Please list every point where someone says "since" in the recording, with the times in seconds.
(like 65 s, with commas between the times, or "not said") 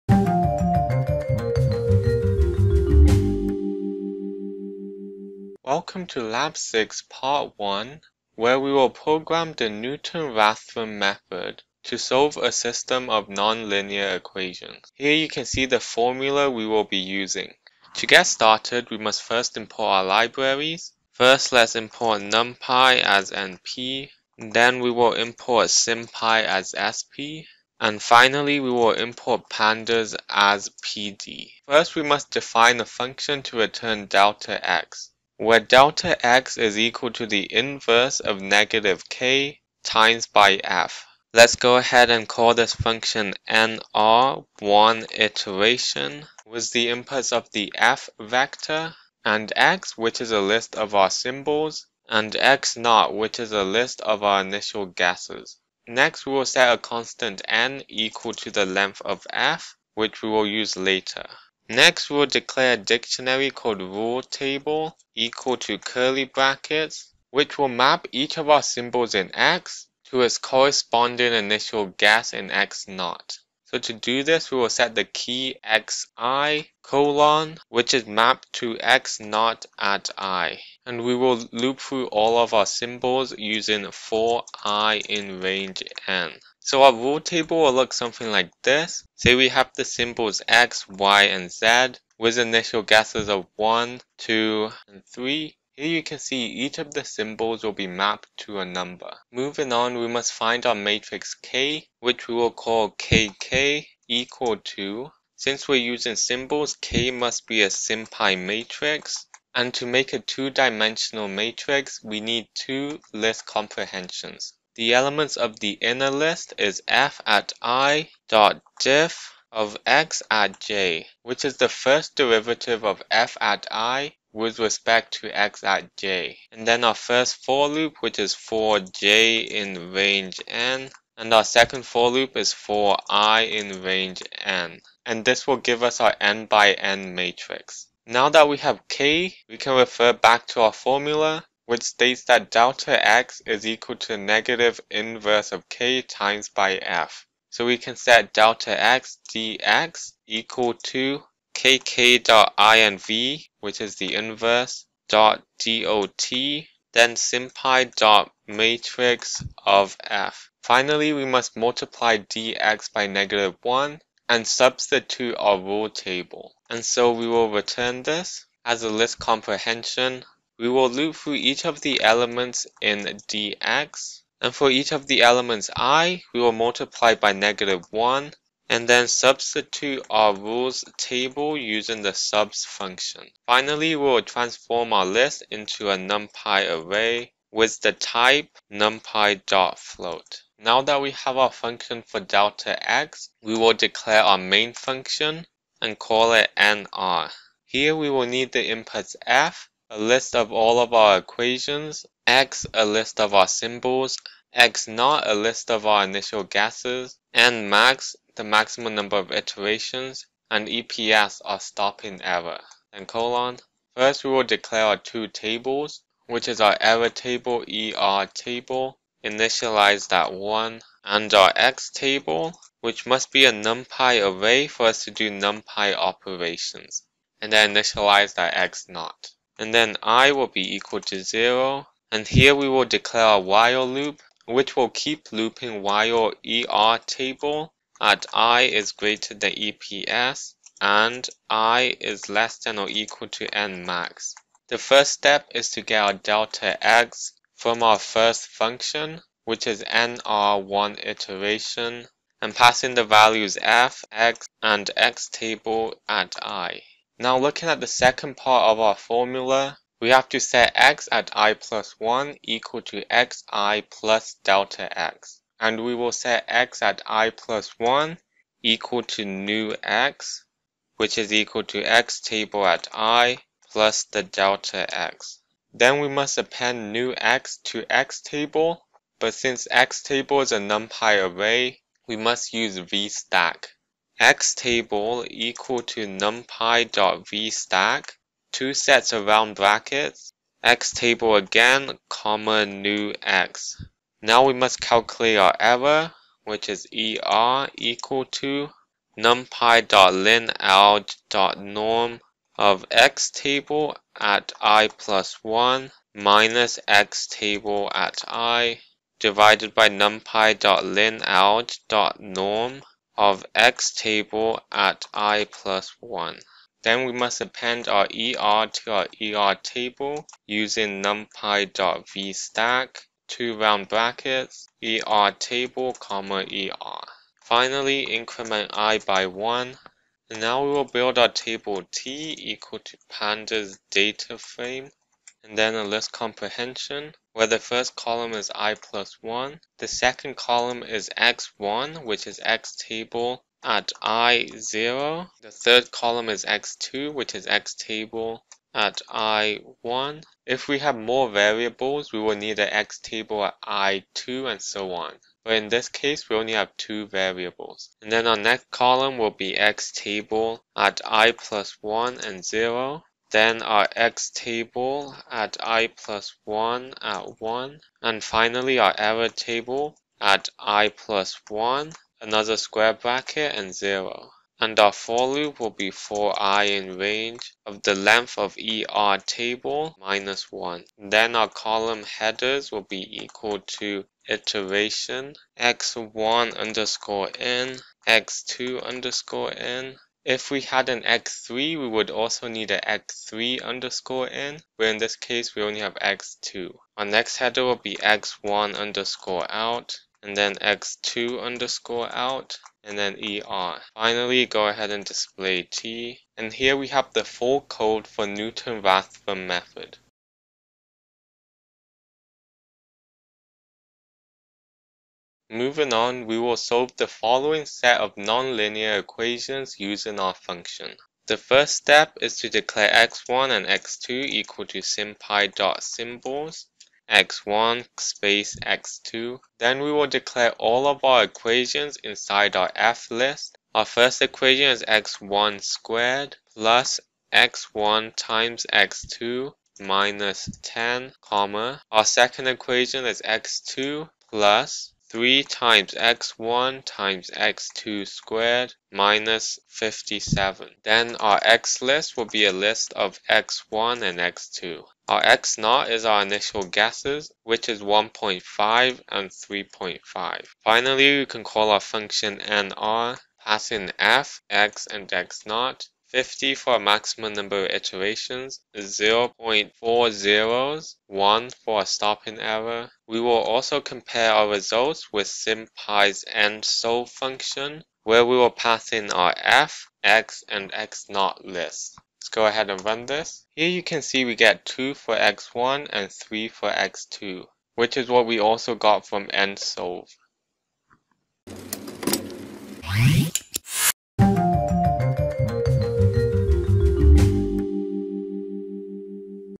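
105 s, 279 s.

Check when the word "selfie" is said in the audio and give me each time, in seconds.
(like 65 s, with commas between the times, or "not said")
not said.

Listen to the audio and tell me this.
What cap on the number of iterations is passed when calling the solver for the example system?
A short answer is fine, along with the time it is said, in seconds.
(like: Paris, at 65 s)
50, at 466 s.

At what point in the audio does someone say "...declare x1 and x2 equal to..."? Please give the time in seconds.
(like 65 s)
422 s.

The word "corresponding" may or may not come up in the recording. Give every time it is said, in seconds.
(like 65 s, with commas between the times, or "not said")
70 s.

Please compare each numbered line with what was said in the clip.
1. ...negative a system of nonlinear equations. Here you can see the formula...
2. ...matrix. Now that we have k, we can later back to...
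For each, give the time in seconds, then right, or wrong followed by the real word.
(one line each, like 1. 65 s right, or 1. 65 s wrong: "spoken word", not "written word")
1. 11 s wrong: "solve", not "negative"
2. 137 s wrong: "refer", not "later".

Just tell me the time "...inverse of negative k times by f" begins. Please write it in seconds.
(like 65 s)
37 s.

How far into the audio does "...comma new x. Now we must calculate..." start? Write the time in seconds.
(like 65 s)
292 s.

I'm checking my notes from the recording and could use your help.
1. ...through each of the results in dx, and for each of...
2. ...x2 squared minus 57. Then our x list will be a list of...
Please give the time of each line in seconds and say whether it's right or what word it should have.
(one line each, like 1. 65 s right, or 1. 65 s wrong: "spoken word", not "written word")
1. 171 s wrong: "elements", not "results"
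2. 447 s right.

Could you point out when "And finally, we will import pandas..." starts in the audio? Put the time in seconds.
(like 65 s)
27 s.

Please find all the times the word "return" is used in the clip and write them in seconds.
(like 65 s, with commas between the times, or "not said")
33 s, 167 s.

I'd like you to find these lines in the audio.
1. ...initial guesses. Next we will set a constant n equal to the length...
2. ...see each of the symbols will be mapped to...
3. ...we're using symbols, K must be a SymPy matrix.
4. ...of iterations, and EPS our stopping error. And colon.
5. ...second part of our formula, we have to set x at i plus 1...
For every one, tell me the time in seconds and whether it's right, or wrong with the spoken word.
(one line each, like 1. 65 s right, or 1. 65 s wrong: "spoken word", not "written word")
1. 54 s right
2. 96 s right
3. 105 s right
4. 209 s right
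5. 257 s right.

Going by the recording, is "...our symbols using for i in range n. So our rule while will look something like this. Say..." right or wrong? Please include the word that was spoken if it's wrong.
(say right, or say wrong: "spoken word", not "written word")
wrong: "table", not "while".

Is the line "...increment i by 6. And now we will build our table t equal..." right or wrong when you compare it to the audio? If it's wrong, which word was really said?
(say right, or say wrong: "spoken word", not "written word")
wrong: "1", not "6".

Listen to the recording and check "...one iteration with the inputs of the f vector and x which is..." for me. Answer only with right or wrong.
right.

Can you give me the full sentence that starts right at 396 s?
Our next header will be x1 underscore out, and then x2 underscore out, and then er.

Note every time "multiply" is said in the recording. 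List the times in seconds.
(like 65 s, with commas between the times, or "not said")
161 s, 176 s.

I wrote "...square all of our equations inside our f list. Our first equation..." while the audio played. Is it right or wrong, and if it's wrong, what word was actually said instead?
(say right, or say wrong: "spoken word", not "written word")
wrong: "declare", not "square".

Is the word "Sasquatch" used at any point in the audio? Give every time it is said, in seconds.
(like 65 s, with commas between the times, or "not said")
not said.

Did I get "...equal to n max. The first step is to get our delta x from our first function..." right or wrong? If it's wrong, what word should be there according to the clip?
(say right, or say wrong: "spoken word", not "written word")
right.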